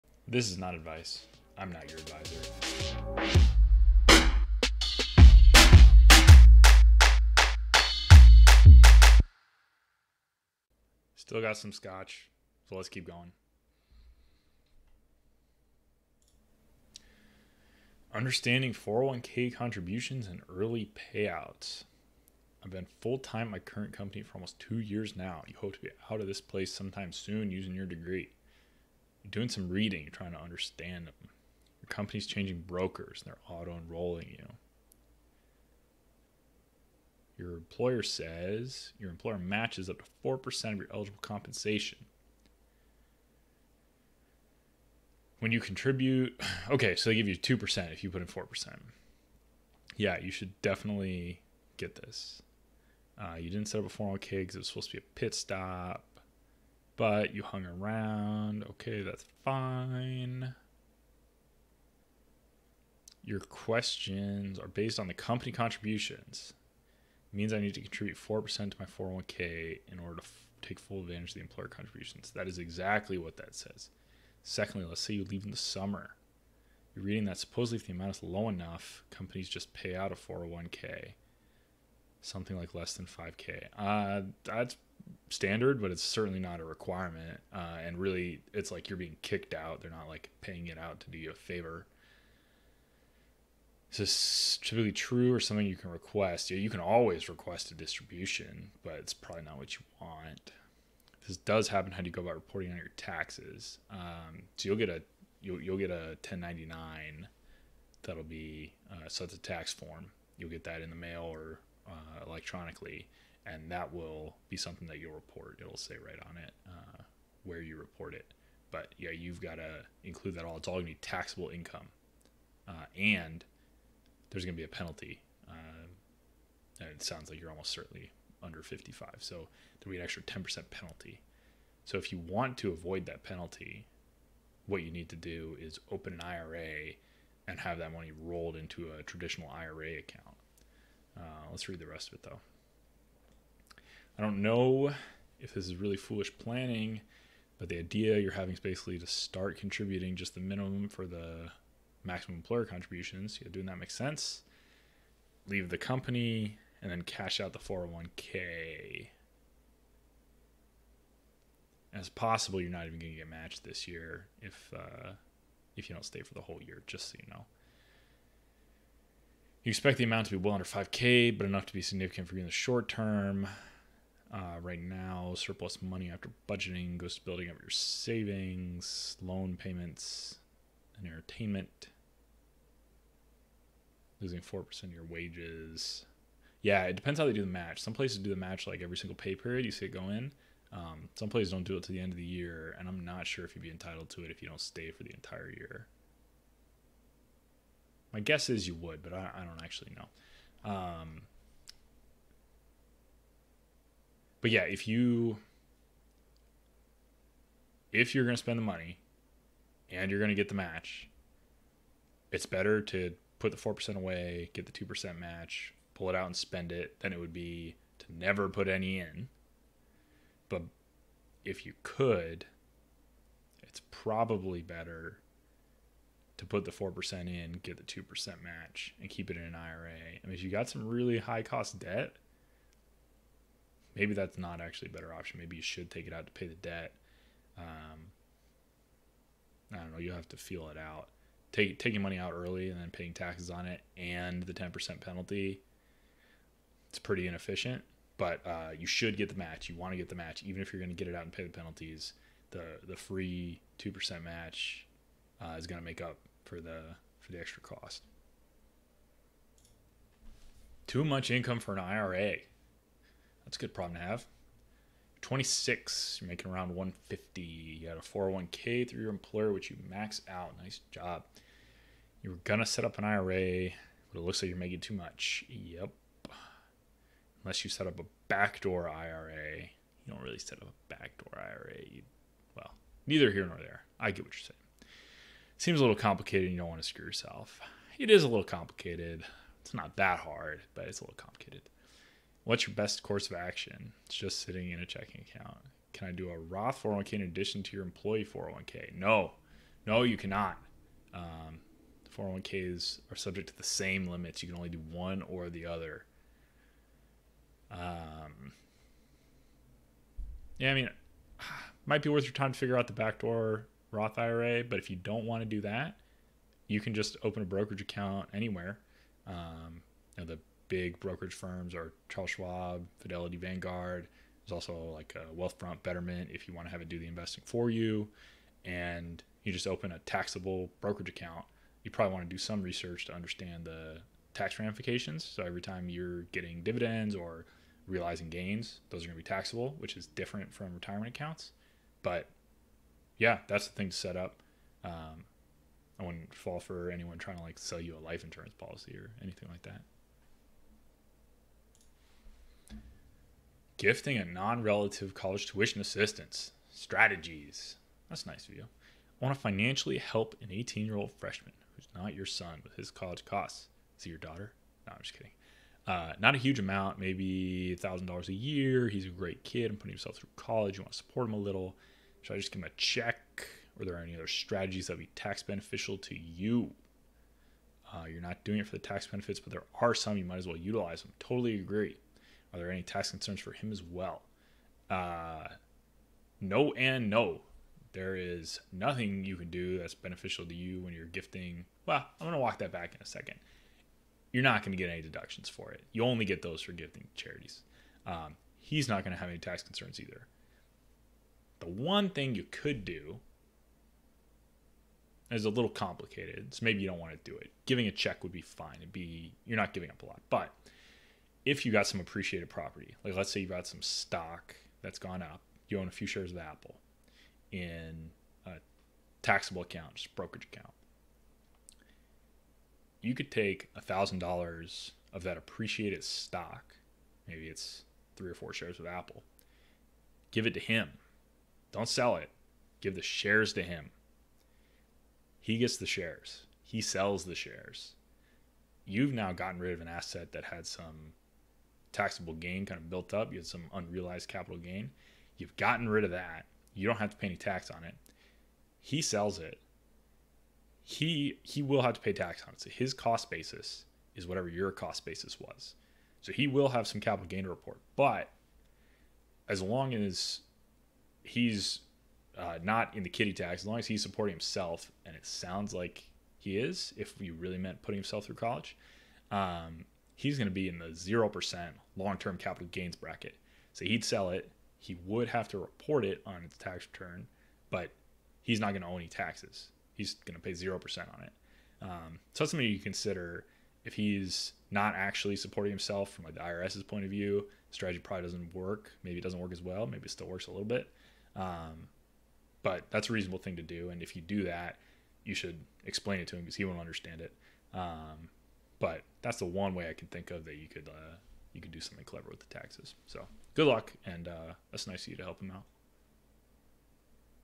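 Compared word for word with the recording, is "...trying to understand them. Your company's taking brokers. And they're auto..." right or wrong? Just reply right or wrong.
wrong.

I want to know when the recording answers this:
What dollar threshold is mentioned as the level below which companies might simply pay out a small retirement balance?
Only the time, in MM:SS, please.
01:22.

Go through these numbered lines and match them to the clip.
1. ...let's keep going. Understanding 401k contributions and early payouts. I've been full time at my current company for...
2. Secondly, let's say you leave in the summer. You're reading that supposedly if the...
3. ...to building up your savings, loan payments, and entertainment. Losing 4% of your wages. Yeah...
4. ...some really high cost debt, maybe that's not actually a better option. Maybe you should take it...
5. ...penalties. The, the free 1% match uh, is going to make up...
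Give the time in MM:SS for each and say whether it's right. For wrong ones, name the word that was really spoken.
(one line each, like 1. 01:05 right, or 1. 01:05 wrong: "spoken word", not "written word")
1. 00:12 right
2. 01:14 right
3. 02:57 right
4. 03:50 right
5. 04:11 wrong: "2", not "1".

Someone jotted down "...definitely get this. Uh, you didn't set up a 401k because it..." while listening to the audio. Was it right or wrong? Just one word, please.
right.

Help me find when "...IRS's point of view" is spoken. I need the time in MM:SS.
08:06.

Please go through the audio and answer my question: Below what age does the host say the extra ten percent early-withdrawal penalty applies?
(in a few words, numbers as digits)
55.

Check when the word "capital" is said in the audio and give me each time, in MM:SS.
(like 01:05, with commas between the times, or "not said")
07:24, 07:37, 07:52.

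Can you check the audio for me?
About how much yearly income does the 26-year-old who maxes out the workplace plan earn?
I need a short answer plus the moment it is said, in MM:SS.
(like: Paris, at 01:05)
150, at 04:26.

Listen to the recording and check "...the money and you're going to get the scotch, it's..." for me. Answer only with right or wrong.
wrong.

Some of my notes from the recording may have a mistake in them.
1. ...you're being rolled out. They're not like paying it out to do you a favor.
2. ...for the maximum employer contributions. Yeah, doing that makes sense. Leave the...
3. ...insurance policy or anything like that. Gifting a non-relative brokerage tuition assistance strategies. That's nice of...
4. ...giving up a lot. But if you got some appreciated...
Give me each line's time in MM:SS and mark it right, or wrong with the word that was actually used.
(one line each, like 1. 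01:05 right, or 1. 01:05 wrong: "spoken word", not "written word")
1. 01:28 wrong: "kicked", not "rolled"
2. 02:30 right
3. 05:48 wrong: "college", not "brokerage"
4. 06:49 right.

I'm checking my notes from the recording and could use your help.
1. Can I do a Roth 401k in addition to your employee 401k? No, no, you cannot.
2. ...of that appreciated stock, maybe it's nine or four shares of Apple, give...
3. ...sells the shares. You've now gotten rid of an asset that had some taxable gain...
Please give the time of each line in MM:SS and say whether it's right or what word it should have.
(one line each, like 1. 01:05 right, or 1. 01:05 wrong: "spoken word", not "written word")
1. 04:55 right
2. 07:05 wrong: "three", not "nine"
3. 07:16 right.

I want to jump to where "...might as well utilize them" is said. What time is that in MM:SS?
06:20.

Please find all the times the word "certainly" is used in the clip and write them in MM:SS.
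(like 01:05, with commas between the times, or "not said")
01:26, 02:07.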